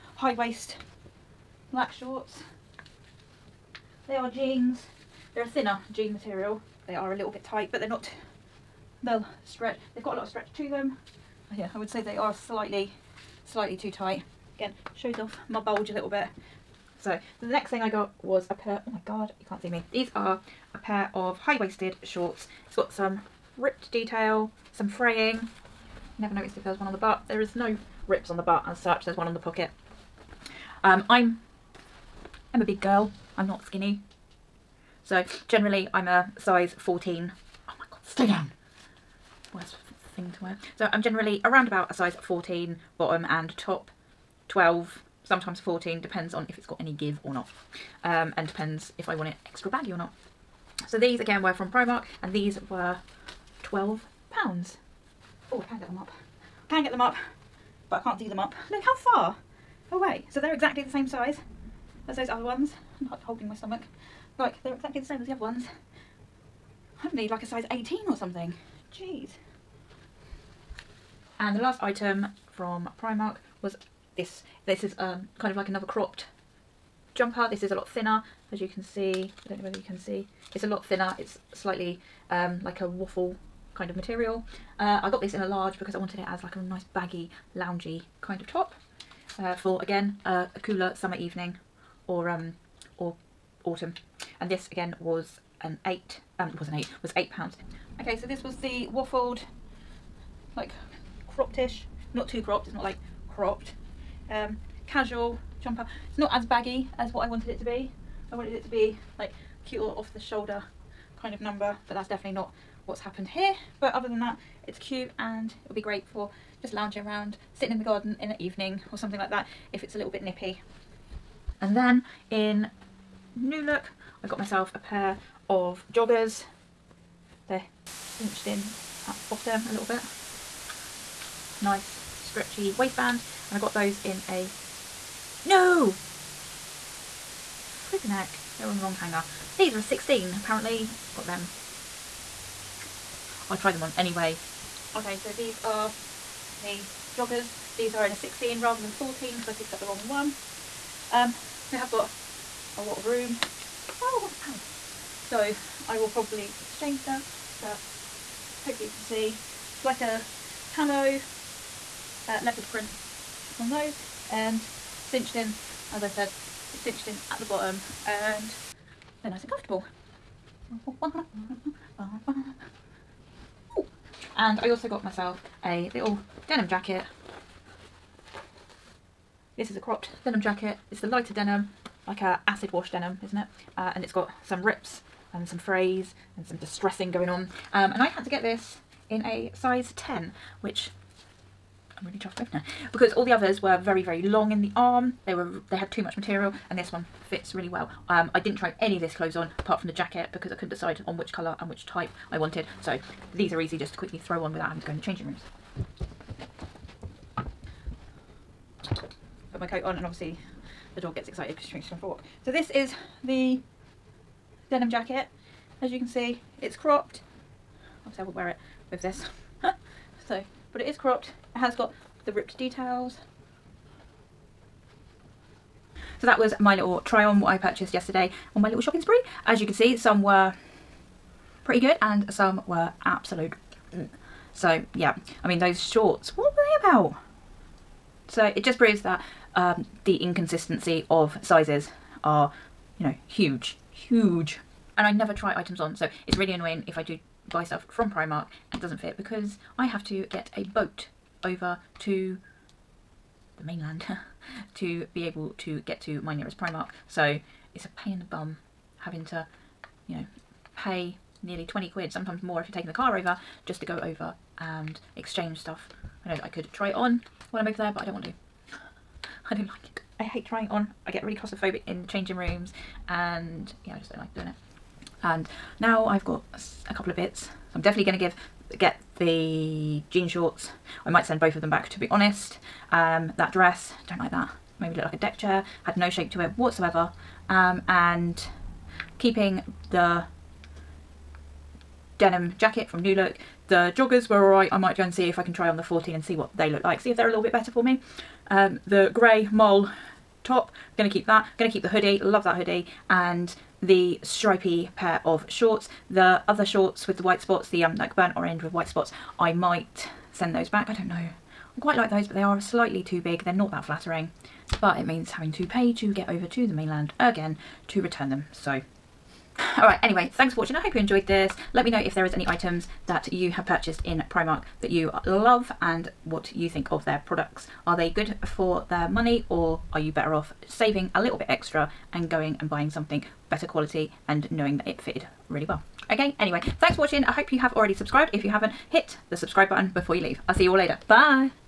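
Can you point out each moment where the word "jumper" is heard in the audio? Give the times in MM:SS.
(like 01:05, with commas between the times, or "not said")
01:17, 01:45.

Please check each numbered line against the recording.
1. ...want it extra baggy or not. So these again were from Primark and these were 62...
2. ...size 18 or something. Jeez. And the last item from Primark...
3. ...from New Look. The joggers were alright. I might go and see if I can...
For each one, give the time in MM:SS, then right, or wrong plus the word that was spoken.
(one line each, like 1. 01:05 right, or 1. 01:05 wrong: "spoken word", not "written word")
1. 00:49 wrong: "12", not "62"
2. 01:07 right
3. 04:52 right.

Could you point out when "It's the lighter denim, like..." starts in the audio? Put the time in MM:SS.
03:00.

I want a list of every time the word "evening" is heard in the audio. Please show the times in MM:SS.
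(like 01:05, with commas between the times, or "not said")
01:31, 01:58.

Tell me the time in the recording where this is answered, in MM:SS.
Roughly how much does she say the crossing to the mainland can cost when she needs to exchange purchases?
04:21.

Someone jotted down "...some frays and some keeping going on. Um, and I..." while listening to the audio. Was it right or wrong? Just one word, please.
wrong.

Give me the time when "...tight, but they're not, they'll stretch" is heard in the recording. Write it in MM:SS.
00:07.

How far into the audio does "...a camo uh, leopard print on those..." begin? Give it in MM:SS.
02:40.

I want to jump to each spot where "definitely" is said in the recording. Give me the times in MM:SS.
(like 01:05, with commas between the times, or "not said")
01:52, 04:37.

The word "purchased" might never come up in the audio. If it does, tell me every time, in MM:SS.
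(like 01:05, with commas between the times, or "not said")
03:47, 05:23.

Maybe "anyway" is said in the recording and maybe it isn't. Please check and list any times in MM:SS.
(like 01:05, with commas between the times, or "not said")
02:23, 05:20, 05:36.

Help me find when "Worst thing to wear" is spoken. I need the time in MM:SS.
00:39.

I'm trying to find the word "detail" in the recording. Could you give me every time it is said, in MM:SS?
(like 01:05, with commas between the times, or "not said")
00:23, 03:42.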